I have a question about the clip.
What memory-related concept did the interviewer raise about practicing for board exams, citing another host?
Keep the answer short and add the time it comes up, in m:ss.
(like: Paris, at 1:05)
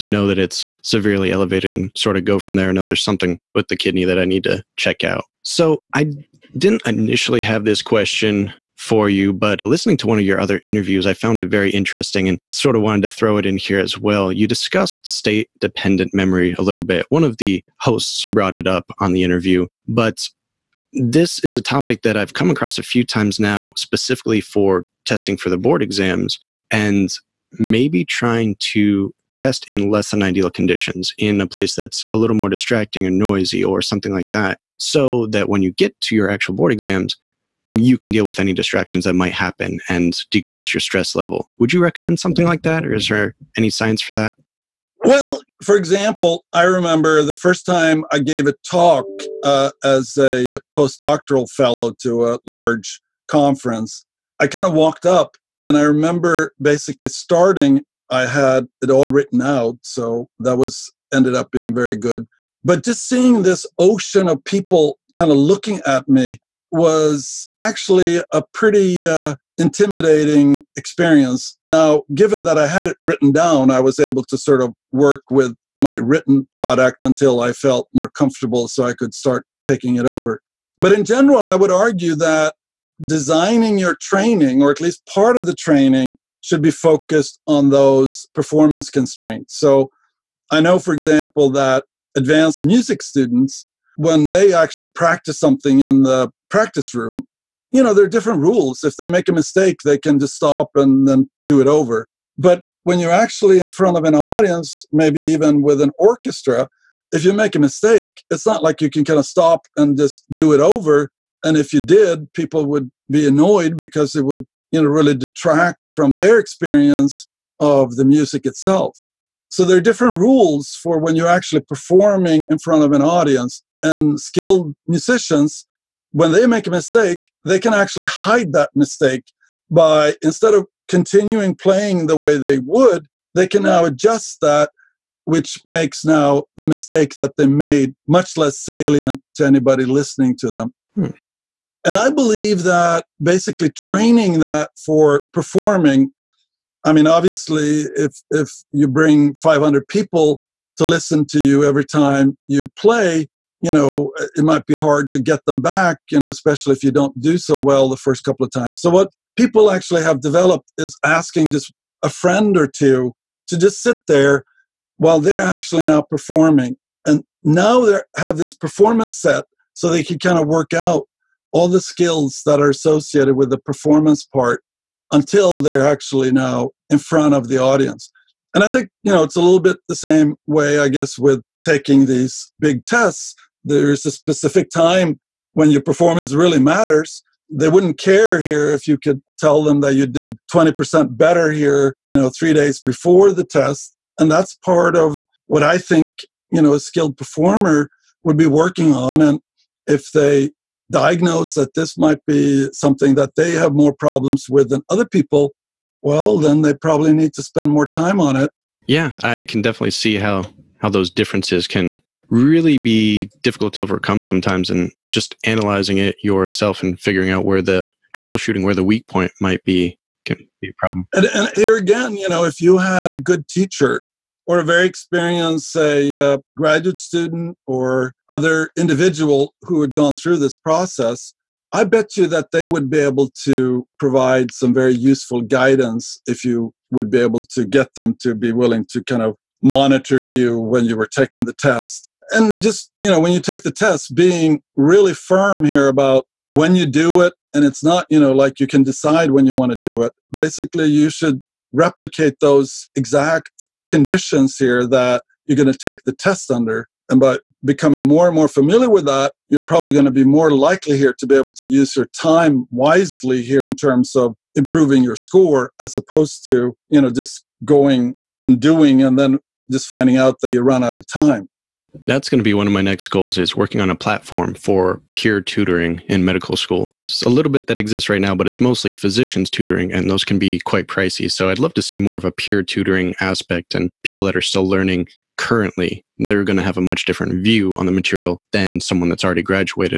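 state dependent memory, at 0:15.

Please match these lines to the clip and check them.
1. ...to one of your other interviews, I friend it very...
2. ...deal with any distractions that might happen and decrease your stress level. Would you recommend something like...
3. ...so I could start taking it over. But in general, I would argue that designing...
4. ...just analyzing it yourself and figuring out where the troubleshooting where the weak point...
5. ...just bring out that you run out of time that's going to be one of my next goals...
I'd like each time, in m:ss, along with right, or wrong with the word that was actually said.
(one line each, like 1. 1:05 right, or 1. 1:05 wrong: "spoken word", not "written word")
1. 0:09 wrong: "found", not "friend"
2. 0:38 right
3. 1:18 right
4. 3:35 right
5. 4:29 wrong: "finding", not "bring".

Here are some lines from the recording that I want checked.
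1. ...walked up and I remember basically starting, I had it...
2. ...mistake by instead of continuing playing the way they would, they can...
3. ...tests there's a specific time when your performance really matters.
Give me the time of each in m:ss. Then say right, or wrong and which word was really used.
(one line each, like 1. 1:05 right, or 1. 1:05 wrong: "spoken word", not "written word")
1. 0:54 right
2. 2:08 right
3. 3:02 right.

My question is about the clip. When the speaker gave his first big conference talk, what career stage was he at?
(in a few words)
postdoctoral fellow.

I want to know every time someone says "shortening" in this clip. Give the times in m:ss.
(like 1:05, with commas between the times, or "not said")
not said.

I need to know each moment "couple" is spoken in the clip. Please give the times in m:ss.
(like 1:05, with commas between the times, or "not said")
2:38.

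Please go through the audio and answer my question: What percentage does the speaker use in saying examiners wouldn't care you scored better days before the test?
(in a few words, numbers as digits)
20%.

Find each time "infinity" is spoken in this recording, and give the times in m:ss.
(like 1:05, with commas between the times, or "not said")
not said.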